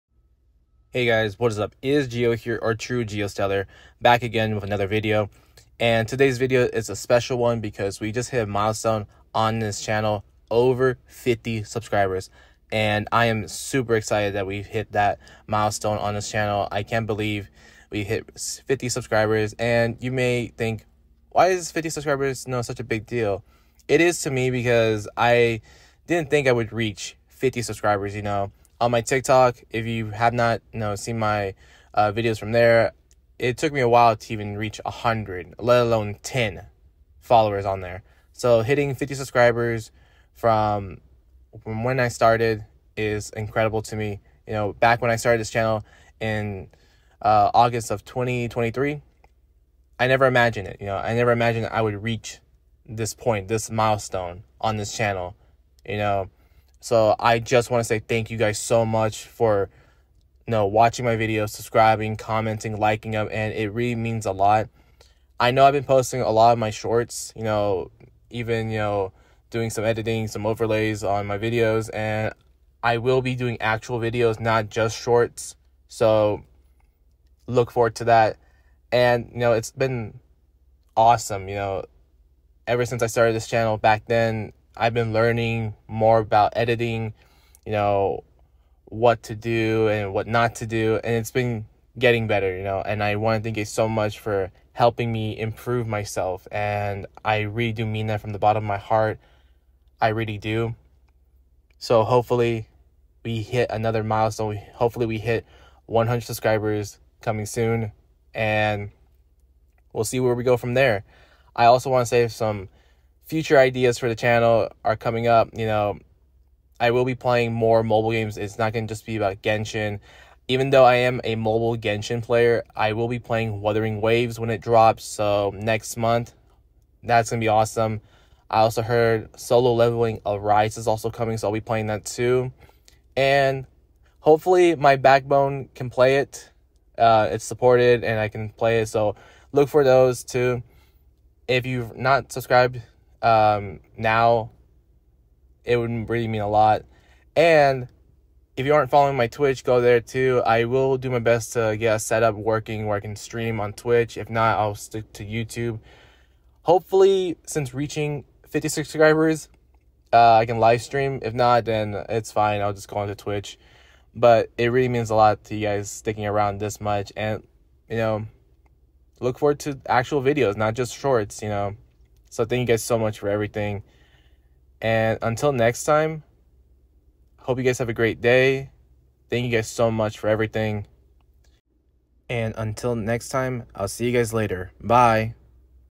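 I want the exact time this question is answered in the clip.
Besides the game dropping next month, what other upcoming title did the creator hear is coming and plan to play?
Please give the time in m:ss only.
2:09.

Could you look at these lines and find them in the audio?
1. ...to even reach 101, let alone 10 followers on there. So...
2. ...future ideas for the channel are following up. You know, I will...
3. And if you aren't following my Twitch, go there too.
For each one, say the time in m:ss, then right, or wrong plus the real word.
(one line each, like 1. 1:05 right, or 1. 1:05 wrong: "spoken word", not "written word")
1. 0:34 wrong: "100", not "101"
2. 1:53 wrong: "coming", not "following"
3. 2:27 right.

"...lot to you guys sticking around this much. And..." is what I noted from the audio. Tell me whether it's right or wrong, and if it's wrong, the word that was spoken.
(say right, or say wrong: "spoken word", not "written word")
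right.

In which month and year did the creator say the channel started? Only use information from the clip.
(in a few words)
August 2023.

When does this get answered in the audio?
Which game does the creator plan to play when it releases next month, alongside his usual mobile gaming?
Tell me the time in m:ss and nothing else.
2:03.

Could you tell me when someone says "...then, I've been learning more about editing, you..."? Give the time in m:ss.
1:24.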